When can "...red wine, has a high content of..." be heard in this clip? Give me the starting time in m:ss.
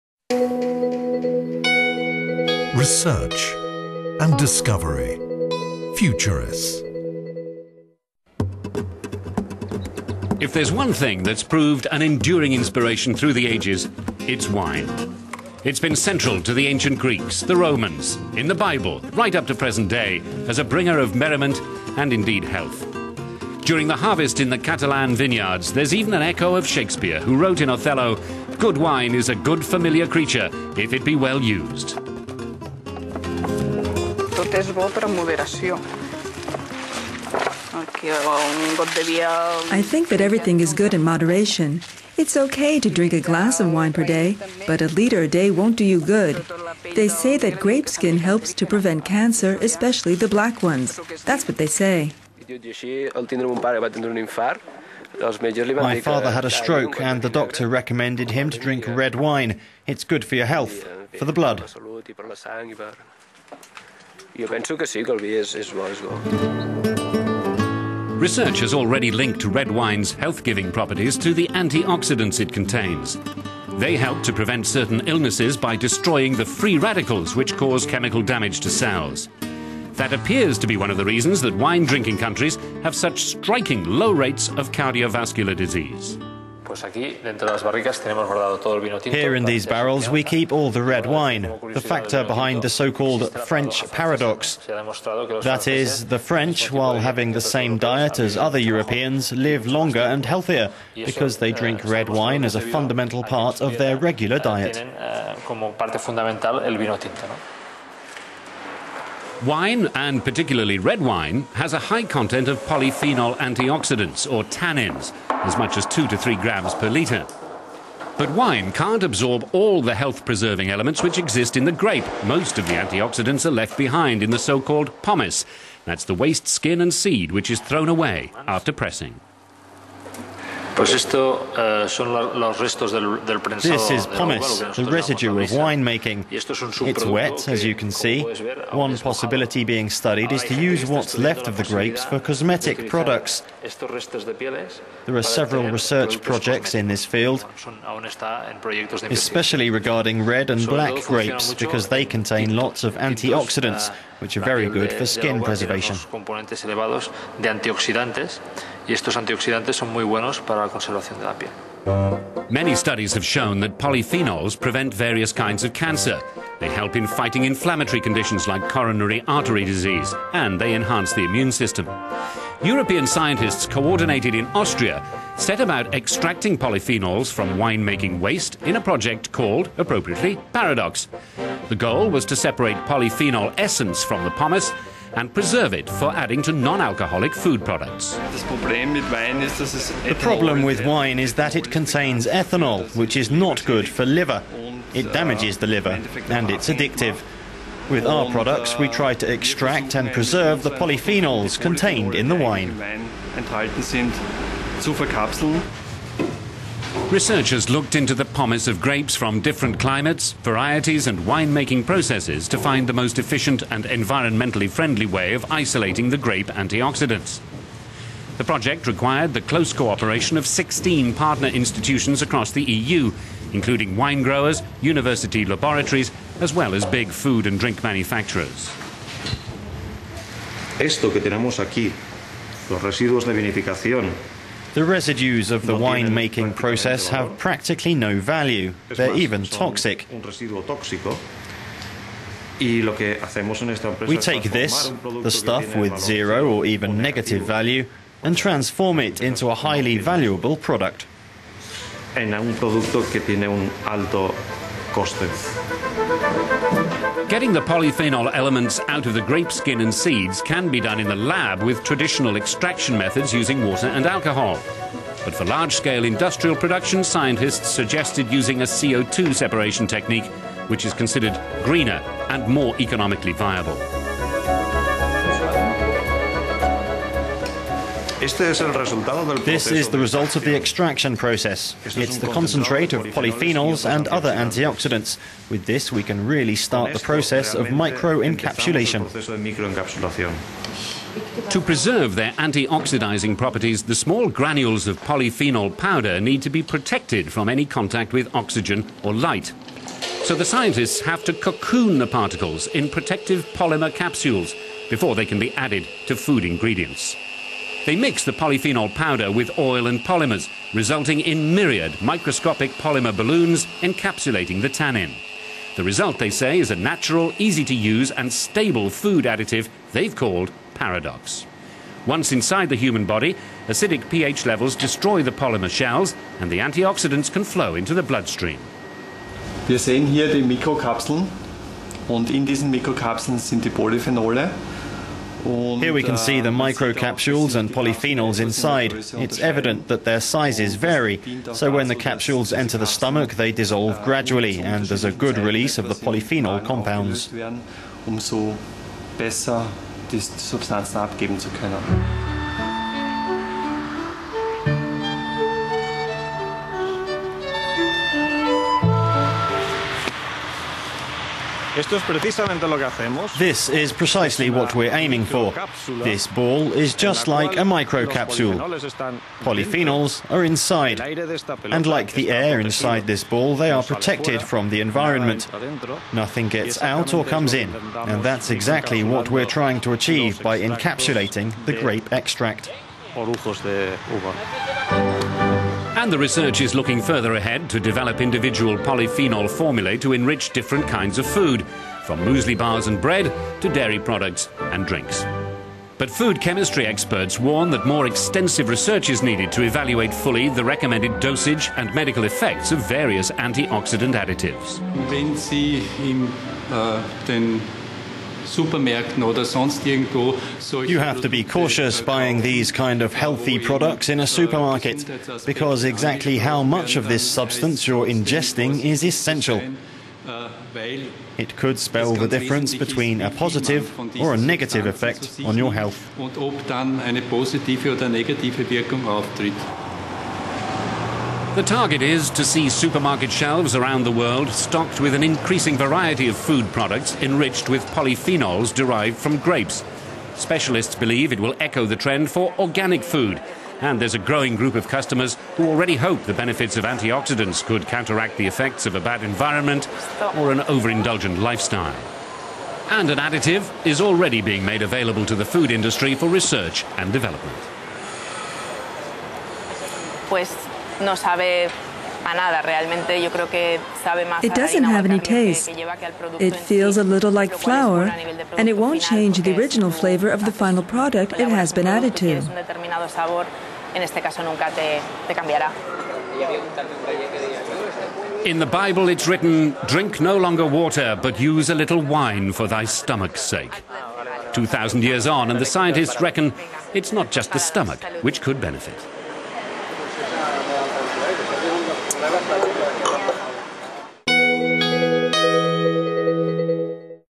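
1:50.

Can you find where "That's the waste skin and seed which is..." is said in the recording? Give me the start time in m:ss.
2:05.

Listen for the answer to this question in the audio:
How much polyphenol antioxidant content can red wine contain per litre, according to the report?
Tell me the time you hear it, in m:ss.
1:55.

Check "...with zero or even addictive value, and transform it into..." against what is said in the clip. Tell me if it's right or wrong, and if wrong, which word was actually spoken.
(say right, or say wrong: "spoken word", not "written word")
wrong: "negative", not "addictive".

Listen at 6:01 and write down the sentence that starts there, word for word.
This is precisely what we're aiming for.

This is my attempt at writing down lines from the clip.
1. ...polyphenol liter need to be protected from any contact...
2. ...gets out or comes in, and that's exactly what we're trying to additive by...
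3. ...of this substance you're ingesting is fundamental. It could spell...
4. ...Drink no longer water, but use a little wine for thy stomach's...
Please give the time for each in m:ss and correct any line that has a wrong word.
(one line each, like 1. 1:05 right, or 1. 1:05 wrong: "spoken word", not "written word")
1. 4:55 wrong: "powder", not "liter"
2. 6:16 wrong: "achieve", not "additive"
3. 6:56 wrong: "essential", not "fundamental"
4. 7:59 right.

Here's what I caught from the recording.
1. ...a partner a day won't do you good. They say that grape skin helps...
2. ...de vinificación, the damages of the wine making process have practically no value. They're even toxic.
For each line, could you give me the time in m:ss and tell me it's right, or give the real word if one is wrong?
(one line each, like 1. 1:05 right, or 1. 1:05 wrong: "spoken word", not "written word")
1. 0:44 wrong: "liter", not "partner"
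2. 3:53 wrong: "residues", not "damages".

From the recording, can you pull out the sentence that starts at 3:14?
It damages the liver and it's addictive.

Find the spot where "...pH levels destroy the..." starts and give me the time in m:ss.
5:24.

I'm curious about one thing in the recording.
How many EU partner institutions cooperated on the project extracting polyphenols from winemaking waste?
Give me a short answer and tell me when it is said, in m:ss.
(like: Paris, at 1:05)
16, at 3:40.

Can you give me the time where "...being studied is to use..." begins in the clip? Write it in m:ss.
2:19.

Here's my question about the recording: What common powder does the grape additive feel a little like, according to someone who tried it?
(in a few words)
flour.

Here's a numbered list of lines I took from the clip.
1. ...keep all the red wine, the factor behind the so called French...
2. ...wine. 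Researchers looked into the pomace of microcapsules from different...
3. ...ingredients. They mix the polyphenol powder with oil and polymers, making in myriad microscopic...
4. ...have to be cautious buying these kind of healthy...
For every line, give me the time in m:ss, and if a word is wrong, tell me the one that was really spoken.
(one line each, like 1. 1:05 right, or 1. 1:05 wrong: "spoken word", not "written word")
1. 1:30 right
2. 3:22 wrong: "grapes", not "microcapsules"
3. 5:06 wrong: "resulting", not "making"
4. 6:50 right.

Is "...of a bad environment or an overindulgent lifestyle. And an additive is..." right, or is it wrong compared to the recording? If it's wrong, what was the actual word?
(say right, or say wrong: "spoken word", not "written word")
right.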